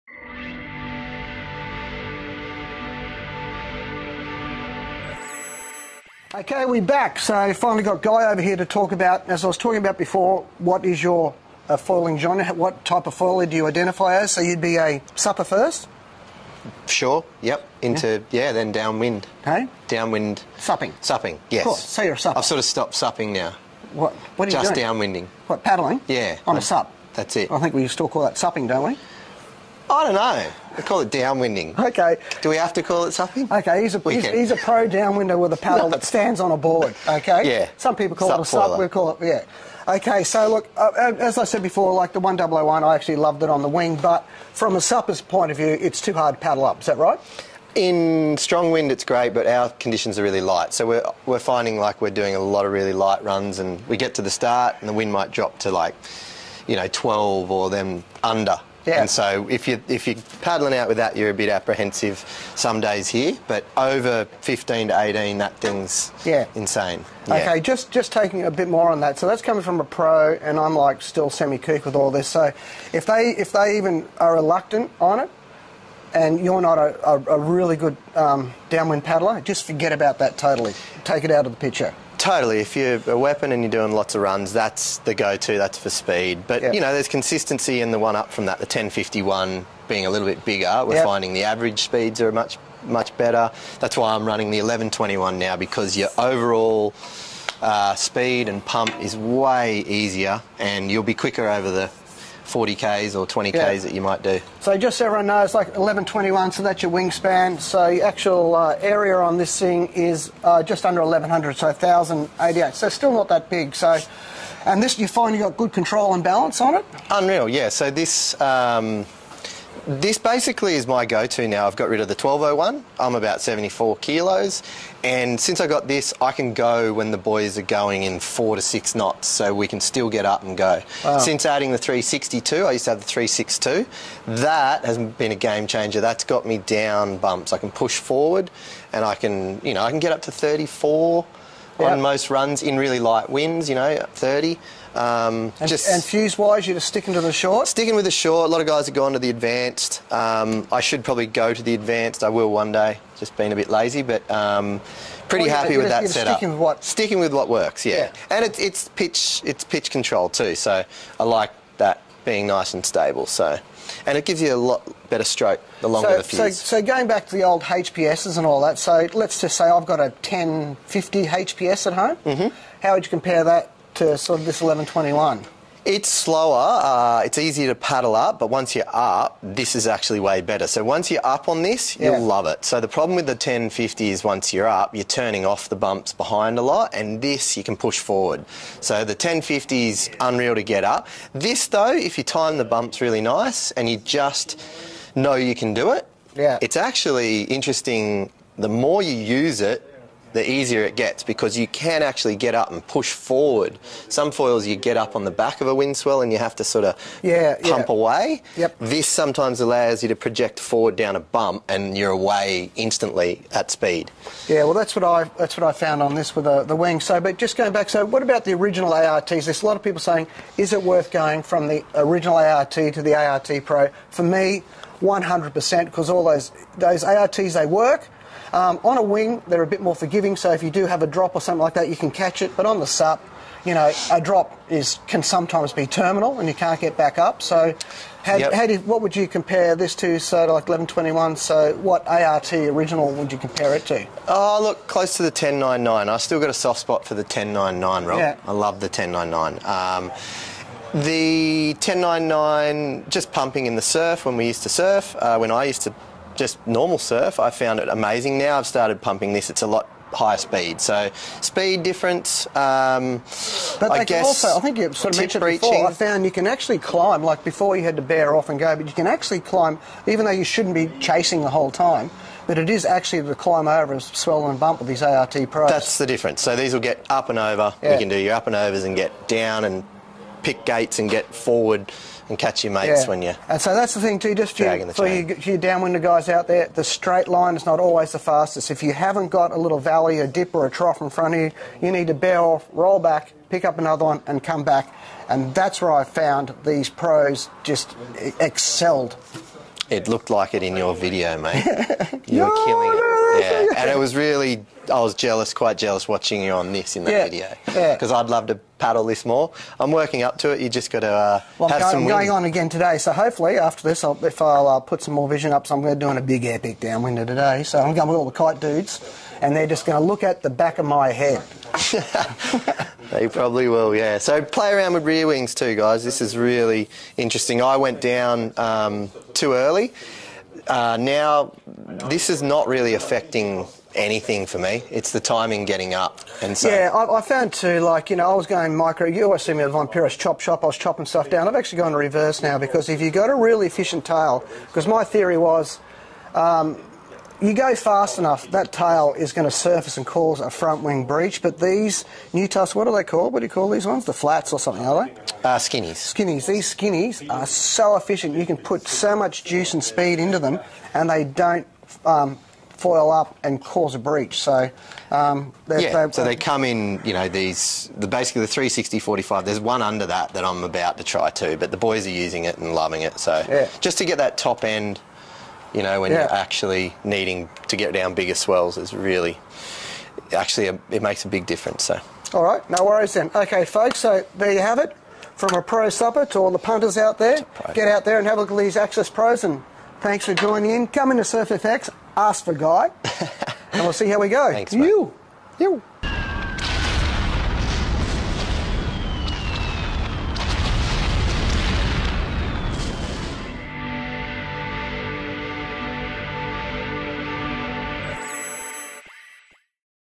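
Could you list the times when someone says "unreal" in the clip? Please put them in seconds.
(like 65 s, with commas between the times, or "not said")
117 s, 190 s.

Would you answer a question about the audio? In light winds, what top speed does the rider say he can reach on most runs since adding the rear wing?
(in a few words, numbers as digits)
34.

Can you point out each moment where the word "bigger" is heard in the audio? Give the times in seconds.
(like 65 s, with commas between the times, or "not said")
90 s, 378 s.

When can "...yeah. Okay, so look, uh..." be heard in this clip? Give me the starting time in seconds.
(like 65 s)
39 s.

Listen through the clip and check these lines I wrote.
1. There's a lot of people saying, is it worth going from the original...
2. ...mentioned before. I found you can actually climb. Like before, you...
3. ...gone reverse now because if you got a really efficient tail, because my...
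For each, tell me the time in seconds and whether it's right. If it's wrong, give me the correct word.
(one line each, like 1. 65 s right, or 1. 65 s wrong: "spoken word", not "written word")
1. 219 s right
2. 265 s right
3. 341 s right.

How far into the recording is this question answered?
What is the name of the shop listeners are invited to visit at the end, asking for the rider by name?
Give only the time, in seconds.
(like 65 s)
391 s.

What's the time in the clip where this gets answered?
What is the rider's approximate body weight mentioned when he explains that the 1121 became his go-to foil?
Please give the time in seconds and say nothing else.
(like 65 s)
123 s.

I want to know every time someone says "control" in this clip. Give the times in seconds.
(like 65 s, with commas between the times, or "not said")
115 s, 159 s.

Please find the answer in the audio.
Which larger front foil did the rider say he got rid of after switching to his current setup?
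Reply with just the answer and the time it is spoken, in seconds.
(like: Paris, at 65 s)
1201, at 122 s.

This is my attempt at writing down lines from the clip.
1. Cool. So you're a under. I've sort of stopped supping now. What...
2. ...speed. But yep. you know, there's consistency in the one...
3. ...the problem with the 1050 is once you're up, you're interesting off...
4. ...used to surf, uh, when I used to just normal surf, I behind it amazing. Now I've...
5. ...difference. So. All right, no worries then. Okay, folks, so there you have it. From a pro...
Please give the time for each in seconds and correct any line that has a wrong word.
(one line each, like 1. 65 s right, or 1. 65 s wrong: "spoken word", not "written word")
1. 21 s wrong: "supper", not "under"
2. 85 s right
3. 182 s wrong: "turning", not "interesting"
4. 254 s wrong: "found", not "behind"
5. 381 s right.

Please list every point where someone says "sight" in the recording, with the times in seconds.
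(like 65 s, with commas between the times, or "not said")
not said.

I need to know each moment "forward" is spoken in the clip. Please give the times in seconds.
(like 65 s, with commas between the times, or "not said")
137 s, 188 s, 203 s, 210 s, 281 s.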